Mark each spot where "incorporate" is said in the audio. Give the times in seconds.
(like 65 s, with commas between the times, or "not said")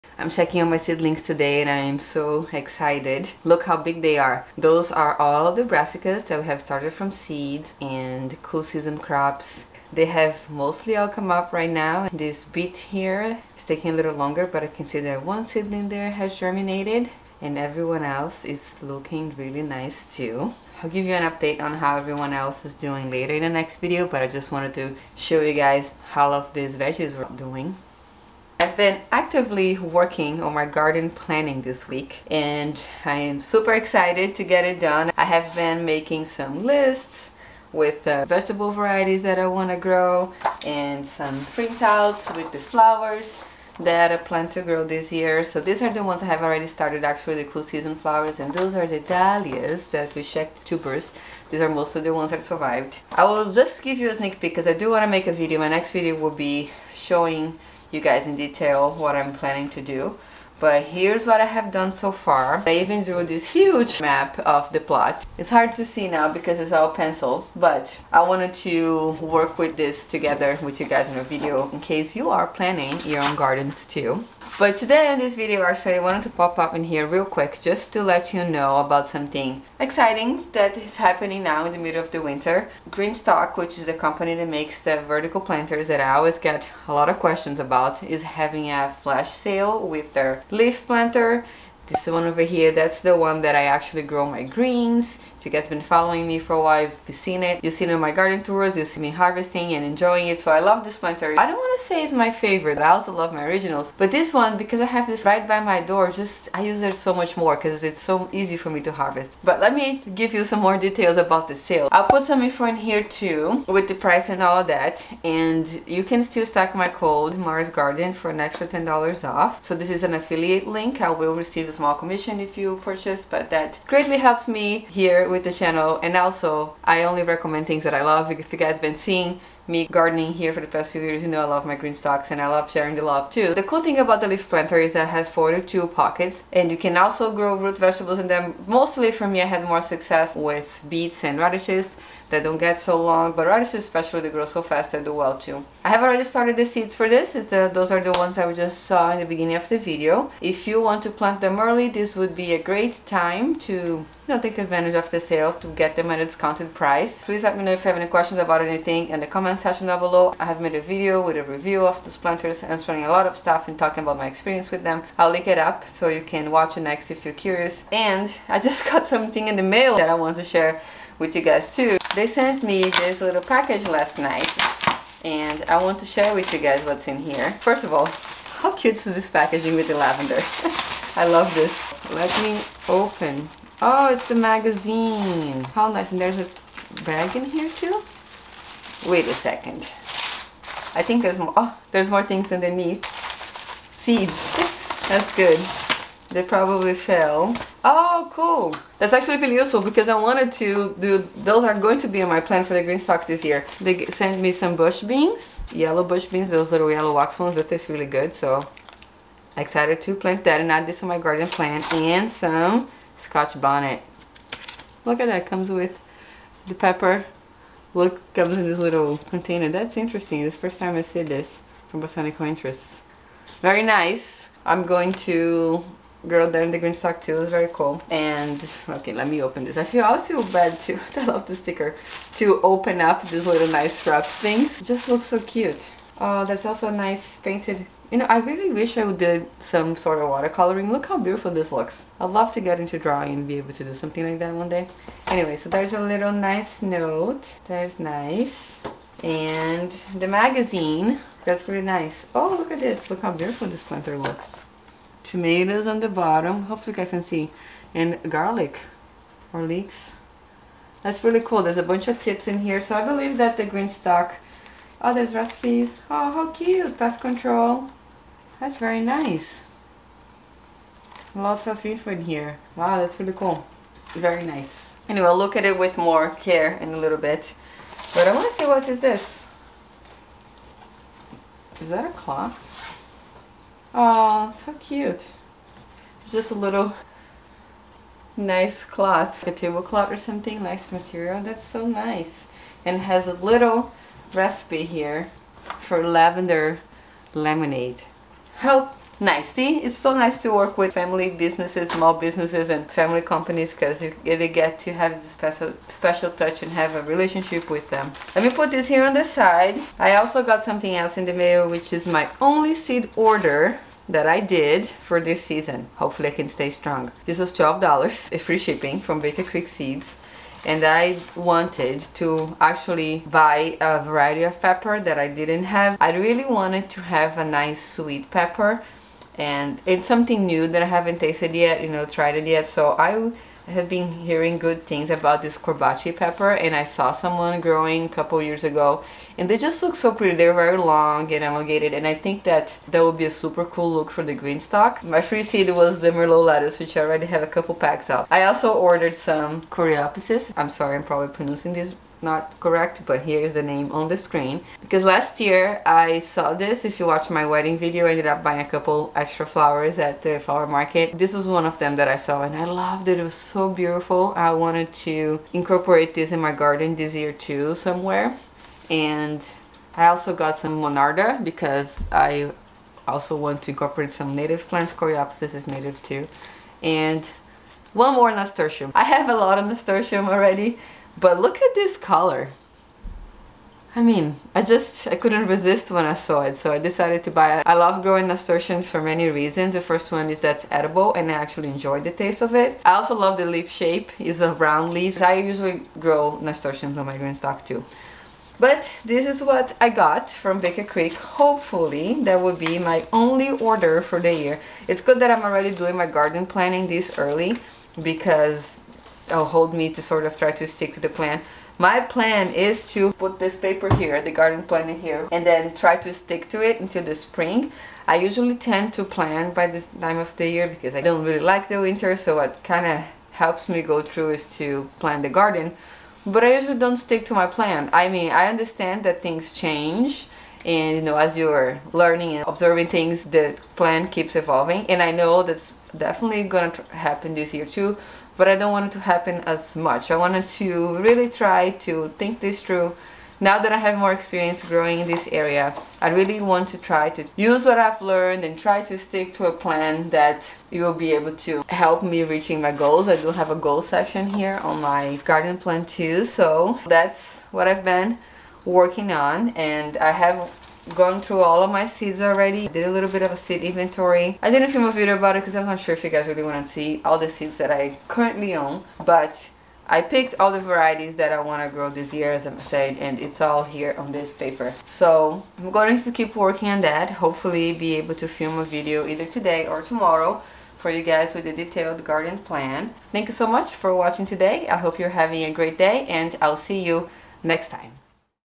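365 s, 373 s.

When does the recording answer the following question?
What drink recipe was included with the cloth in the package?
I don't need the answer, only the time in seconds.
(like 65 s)
296 s.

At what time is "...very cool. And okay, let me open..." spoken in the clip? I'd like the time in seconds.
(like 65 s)
227 s.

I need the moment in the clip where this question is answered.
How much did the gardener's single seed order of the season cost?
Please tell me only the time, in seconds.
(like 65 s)
317 s.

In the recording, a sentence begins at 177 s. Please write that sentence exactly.
First of all, how cute is this packaging with the lavender?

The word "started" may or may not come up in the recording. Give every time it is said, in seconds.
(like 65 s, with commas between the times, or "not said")
6 s, 46 s, 146 s.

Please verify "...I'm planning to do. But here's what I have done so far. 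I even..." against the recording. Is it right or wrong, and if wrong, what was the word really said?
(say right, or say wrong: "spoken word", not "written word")
right.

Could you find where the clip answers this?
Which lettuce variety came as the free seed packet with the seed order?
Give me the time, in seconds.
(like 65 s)
346 s.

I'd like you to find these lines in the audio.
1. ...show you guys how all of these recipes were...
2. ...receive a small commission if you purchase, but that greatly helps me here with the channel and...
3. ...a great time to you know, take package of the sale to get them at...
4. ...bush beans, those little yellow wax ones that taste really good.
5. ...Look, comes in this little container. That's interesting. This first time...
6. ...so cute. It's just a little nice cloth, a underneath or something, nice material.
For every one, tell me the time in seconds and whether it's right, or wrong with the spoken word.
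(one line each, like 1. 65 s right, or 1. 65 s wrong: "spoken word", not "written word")
1. 25 s wrong: "veggies", not "recipes"
2. 121 s right
3. 152 s wrong: "advantage", not "package"
4. 206 s right
5. 217 s right
6. 284 s wrong: "tablecloth", not "underneath".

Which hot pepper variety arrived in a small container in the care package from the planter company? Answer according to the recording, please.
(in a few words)
Scotch bonnet.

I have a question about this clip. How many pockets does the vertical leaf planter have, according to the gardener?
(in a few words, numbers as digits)
42.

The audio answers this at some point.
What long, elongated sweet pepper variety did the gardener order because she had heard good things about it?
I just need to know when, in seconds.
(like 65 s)
335 s.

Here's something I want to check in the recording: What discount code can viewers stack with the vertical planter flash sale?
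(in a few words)
Maris Garden.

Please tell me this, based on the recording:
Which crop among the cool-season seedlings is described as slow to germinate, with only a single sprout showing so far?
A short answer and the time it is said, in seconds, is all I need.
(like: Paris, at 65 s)
Beet, at 12 s.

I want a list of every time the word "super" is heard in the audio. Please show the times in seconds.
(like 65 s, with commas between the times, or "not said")
33 s, 343 s.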